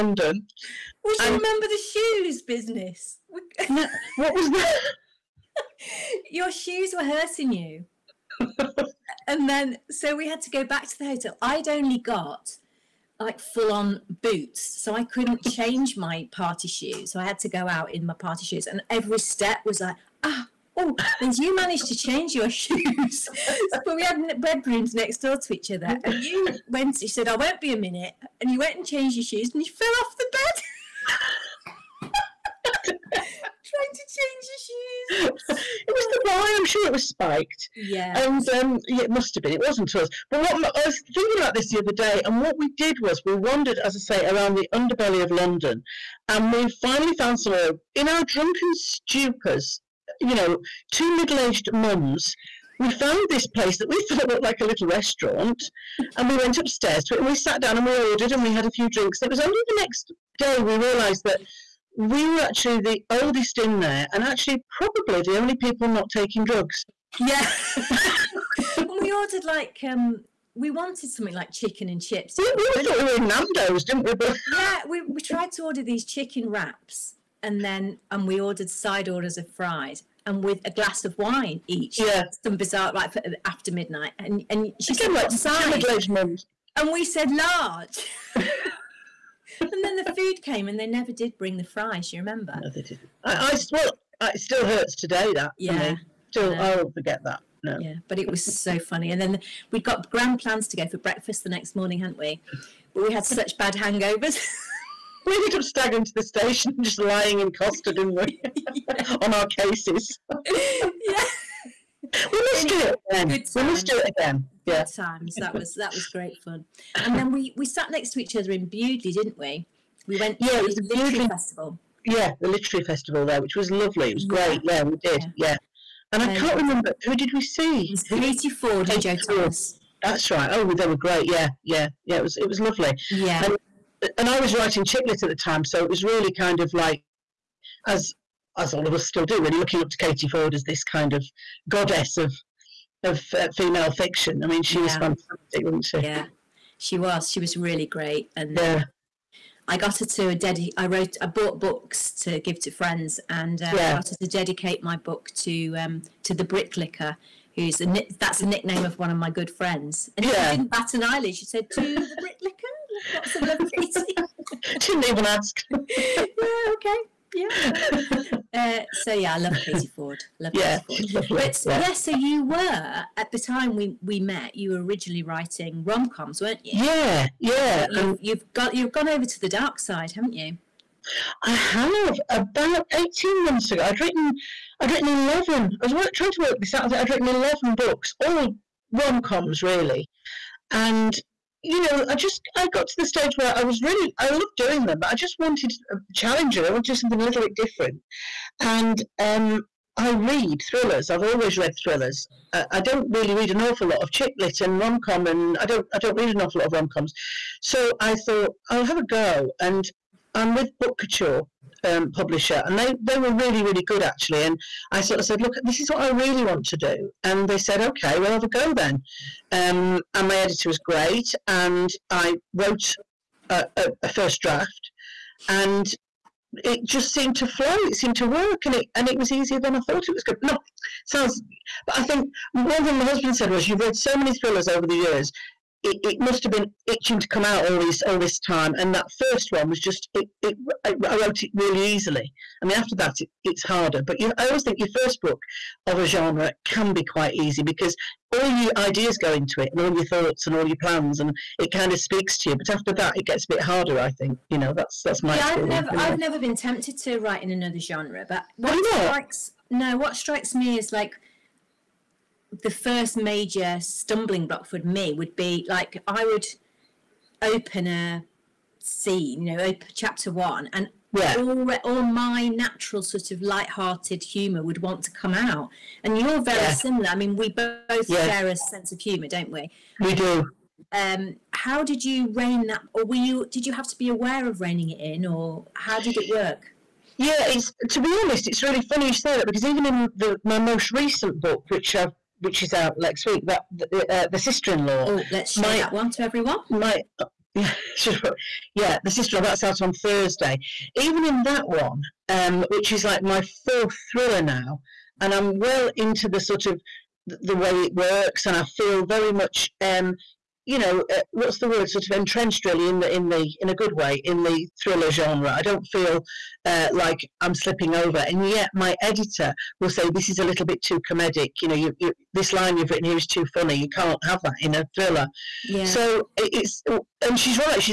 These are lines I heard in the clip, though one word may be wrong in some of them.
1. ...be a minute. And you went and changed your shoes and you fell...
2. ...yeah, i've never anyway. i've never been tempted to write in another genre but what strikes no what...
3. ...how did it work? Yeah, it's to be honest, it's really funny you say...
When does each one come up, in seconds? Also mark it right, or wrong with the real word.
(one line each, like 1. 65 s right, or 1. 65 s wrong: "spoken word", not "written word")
1. 27 s right
2. 255 s right
3. 285 s right.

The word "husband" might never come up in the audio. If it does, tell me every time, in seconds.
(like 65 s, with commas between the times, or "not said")
233 s.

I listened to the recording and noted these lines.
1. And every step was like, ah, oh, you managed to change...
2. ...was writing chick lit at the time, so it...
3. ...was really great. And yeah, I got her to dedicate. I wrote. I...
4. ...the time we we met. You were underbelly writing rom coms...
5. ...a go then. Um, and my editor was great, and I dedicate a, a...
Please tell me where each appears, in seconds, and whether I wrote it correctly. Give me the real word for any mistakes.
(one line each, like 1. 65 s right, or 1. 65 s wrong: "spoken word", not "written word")
1. 18 s right
2. 134 s right
3. 147 s right
4. 173 s wrong: "originally", not "underbelly"
5. 218 s wrong: "wrote", not "dedicate".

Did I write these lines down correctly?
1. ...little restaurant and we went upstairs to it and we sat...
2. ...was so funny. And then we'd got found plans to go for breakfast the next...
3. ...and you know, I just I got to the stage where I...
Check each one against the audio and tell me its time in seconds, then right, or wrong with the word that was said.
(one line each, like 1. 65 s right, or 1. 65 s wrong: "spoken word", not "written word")
1. 54 s right
2. 98 s wrong: "grand", not "found"
3. 190 s right.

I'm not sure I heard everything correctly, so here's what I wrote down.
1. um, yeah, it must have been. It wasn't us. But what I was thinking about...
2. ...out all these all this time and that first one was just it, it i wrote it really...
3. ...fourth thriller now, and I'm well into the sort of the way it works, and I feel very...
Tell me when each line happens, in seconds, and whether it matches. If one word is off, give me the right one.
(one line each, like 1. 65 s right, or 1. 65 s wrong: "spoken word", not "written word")
1. 38 s right
2. 237 s right
3. 303 s right.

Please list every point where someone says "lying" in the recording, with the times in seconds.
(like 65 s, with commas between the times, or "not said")
106 s.